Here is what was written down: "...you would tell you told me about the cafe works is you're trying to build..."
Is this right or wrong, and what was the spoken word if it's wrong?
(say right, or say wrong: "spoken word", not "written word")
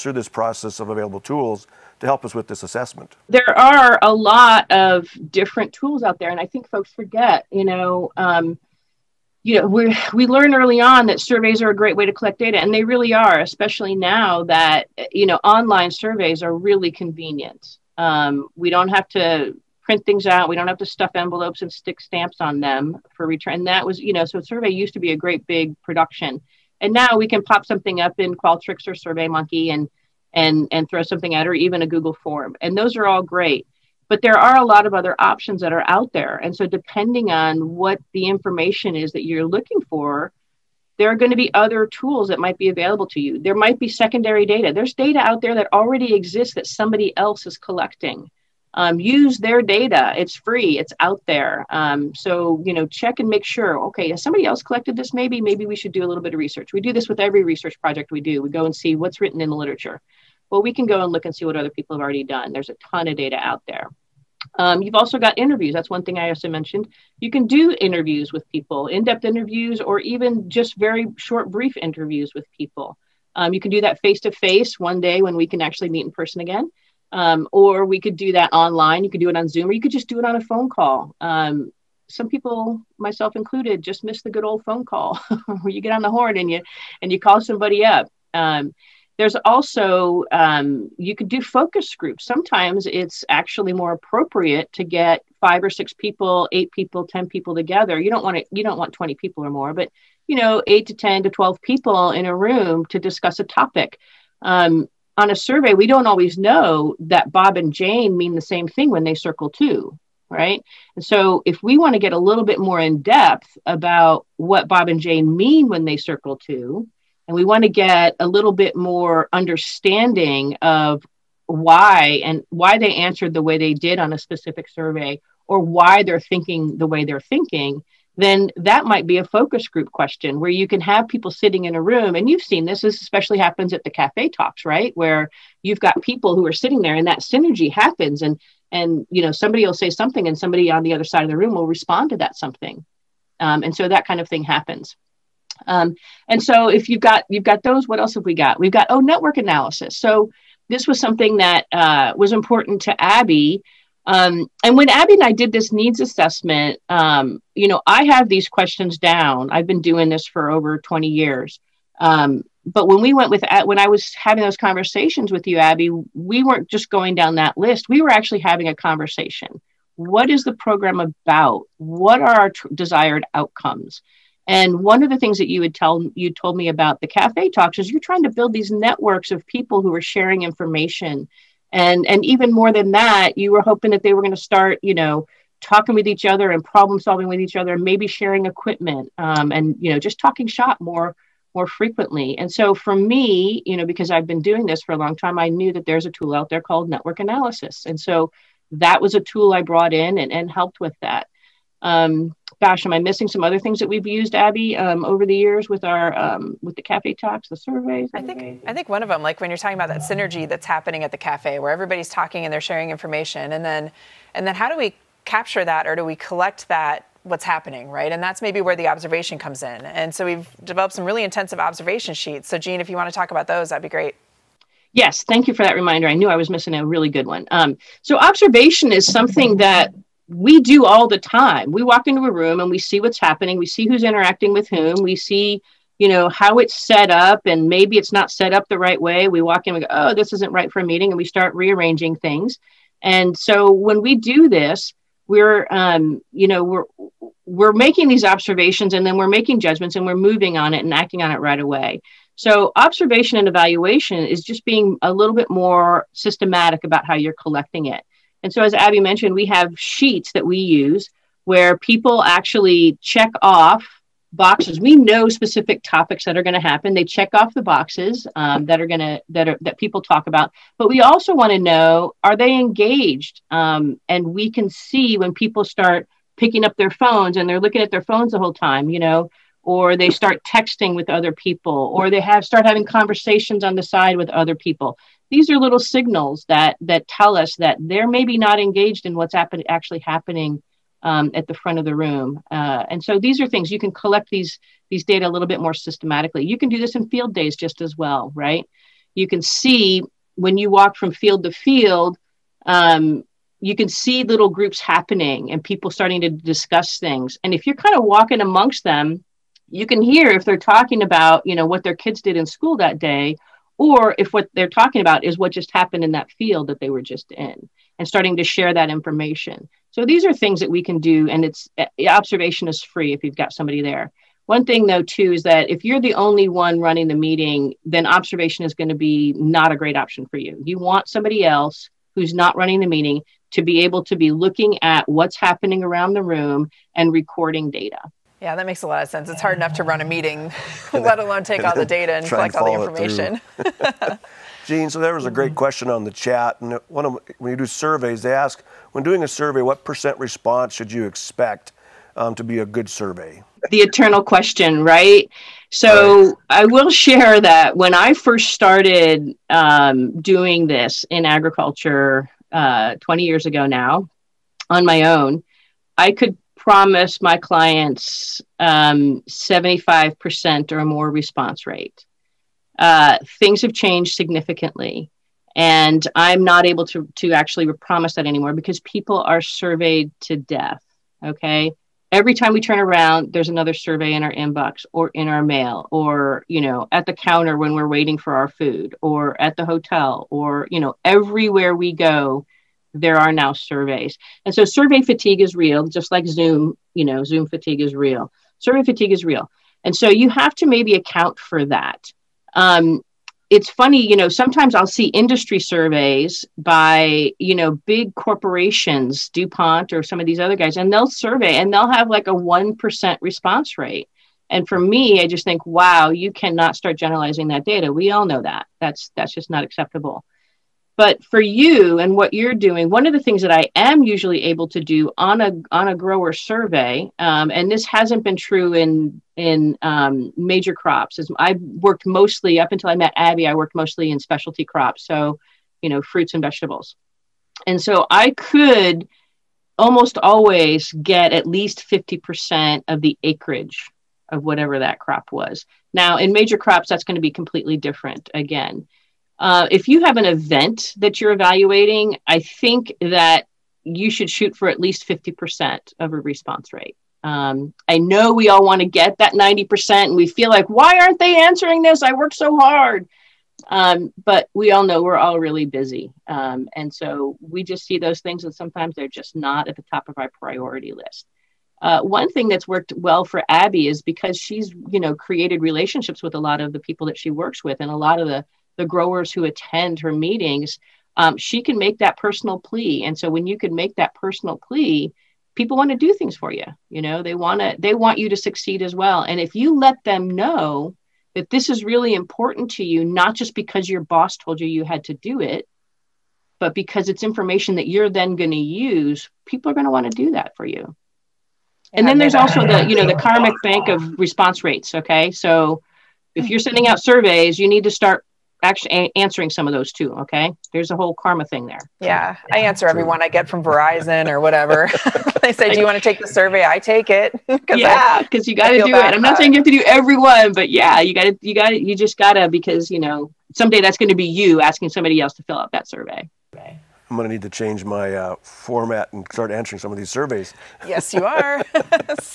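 wrong: "talks", not "works".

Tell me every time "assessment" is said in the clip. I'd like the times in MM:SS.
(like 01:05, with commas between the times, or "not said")
00:02, 02:35.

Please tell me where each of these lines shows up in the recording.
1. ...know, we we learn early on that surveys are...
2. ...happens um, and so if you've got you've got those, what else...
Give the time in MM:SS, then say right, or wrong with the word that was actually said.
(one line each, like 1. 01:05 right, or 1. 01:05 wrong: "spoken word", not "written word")
1. 00:09 right
2. 02:24 right.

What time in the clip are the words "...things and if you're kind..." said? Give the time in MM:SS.
05:06.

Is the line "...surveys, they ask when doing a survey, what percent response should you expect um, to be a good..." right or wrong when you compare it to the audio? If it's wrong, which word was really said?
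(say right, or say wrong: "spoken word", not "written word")
right.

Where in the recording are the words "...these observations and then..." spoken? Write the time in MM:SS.
04:08.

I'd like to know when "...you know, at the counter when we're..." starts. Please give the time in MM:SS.
06:26.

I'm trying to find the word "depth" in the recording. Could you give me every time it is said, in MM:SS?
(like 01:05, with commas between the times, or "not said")
01:09, 01:53.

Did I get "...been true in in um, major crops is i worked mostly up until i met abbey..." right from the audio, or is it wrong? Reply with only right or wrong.
right.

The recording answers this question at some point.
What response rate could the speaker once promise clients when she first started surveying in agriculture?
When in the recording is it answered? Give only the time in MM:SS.
06:09.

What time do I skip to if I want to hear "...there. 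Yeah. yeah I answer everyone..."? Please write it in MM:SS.
08:31.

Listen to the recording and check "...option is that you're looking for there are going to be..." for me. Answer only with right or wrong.
wrong.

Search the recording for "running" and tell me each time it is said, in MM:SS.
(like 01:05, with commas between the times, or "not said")
05:26, 05:32.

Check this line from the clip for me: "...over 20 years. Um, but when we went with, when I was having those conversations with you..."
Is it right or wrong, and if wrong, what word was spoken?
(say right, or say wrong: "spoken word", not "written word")
right.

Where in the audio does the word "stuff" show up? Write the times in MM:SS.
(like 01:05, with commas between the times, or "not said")
00:20.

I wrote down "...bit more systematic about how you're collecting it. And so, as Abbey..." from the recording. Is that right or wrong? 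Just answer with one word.
right.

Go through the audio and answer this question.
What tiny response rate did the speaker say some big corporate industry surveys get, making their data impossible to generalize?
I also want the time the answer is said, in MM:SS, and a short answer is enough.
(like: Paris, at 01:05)
1%, at 06:52.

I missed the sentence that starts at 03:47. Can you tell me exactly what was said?
Um, so, observation is something that we do all the time.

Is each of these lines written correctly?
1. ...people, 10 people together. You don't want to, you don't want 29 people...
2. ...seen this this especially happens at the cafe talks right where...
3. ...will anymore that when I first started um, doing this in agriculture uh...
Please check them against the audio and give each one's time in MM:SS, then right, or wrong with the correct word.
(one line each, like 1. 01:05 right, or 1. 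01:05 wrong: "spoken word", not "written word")
1. 01:36 wrong: "20", not "29"
2. 02:12 right
3. 05:56 wrong: "share", not "anymore".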